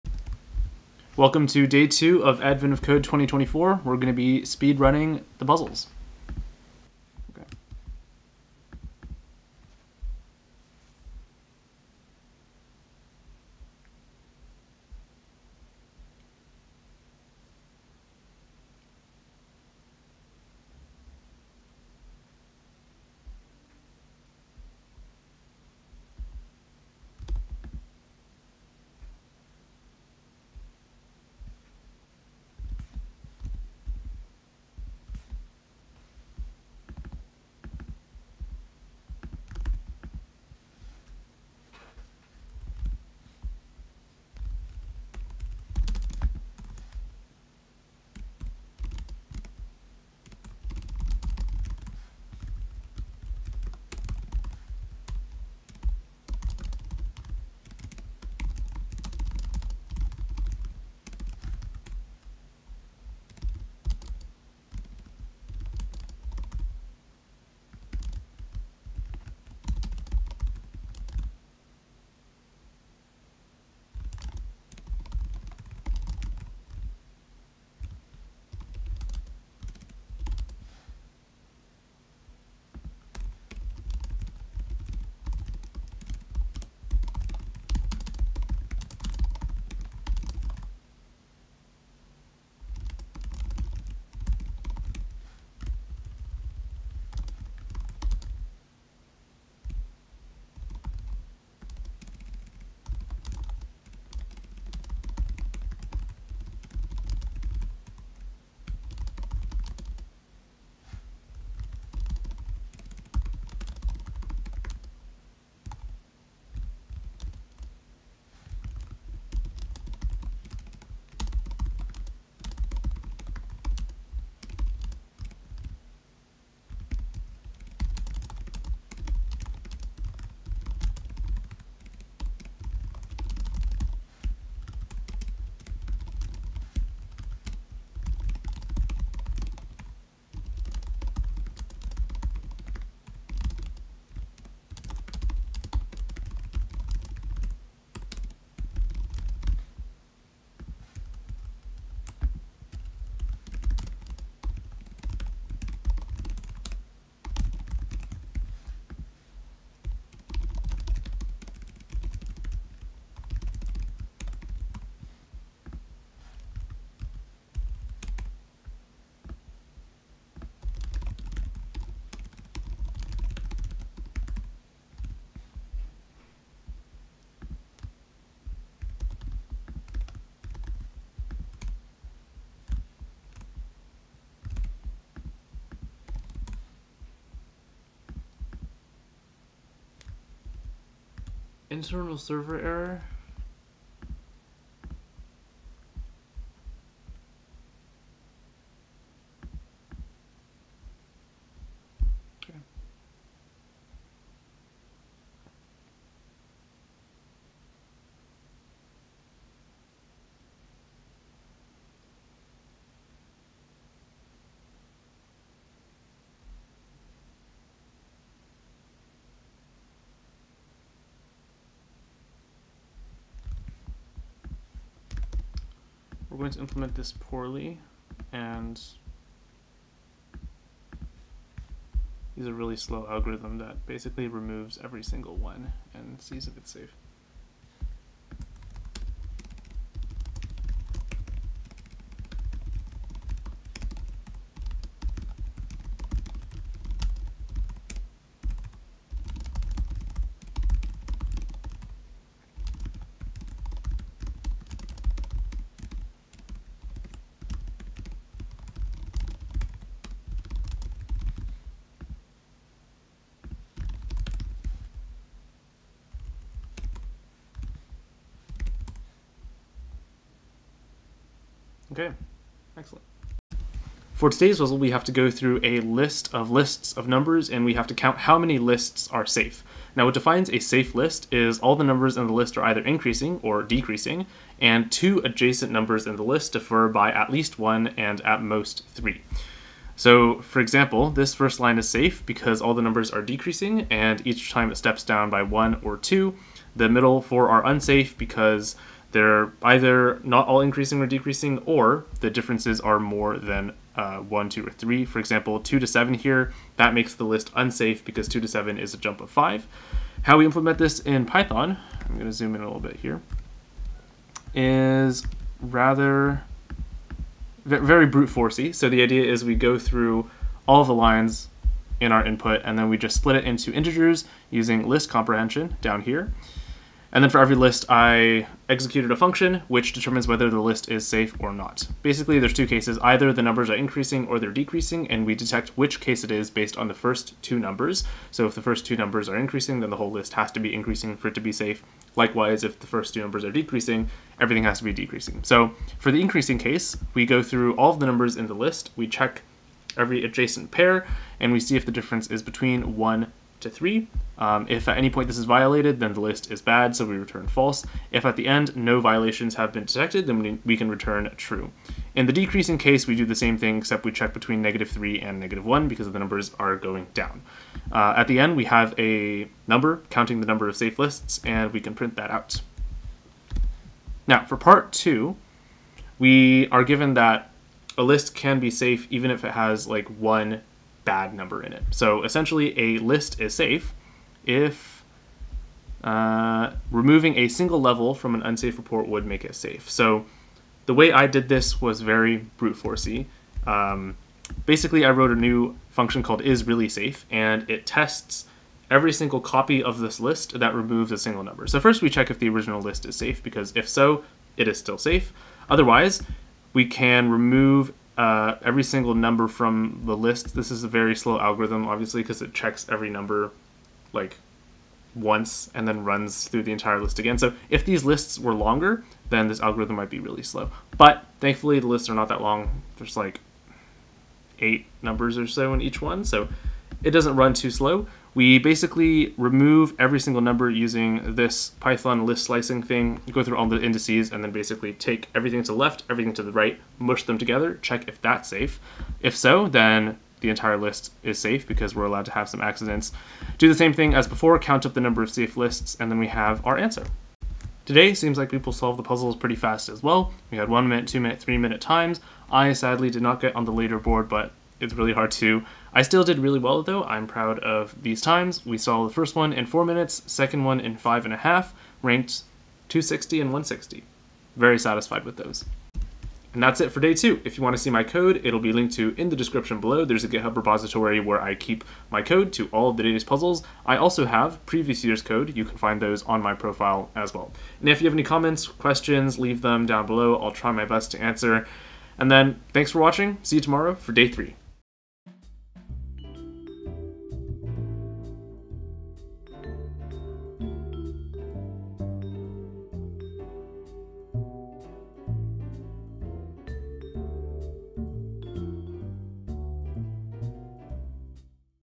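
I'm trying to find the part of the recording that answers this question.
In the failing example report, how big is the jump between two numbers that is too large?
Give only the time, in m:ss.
5:08.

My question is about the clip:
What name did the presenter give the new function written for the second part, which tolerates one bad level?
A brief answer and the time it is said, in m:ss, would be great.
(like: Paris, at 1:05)
is really safe, at 6:36.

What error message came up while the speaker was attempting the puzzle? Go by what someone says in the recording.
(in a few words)
Internal server error.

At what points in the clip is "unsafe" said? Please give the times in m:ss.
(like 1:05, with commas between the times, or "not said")
4:57, 5:07, 6:28.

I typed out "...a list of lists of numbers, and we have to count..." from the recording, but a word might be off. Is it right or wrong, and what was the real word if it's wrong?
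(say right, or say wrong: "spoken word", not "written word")
right.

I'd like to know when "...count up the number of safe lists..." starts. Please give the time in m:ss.
7:24.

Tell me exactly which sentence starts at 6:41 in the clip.
So first we check if the original list is safe, because if so, it is still safe.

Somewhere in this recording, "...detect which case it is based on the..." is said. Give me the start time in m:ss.
5:35.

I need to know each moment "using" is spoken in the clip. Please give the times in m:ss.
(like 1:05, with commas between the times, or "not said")
5:24, 7:10.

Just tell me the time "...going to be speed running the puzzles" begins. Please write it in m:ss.
0:03.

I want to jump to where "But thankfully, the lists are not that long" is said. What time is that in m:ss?
7:00.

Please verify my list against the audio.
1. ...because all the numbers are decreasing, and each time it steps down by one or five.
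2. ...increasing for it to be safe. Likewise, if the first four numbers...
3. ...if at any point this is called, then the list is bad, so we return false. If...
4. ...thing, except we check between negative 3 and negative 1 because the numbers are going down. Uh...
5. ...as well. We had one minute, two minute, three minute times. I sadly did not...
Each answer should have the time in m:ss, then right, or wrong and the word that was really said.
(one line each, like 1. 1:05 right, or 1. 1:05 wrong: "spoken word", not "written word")
1. 4:52 wrong: "two", not "five"
2. 5:40 wrong: "two", not "four"
3. 5:54 wrong: "violated", not "called"
4. 6:03 right
5. 7:29 right.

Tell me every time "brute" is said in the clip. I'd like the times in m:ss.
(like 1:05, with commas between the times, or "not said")
5:18, 6:32.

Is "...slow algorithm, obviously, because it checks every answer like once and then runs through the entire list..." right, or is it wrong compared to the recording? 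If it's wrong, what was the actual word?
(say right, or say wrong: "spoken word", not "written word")
wrong: "number", not "answer".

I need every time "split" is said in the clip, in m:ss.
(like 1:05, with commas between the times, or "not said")
5:23.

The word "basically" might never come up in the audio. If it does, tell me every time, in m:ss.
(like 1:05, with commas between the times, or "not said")
3:53, 5:32, 6:34, 7:08, 7:14.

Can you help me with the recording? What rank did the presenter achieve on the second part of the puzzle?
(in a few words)
160.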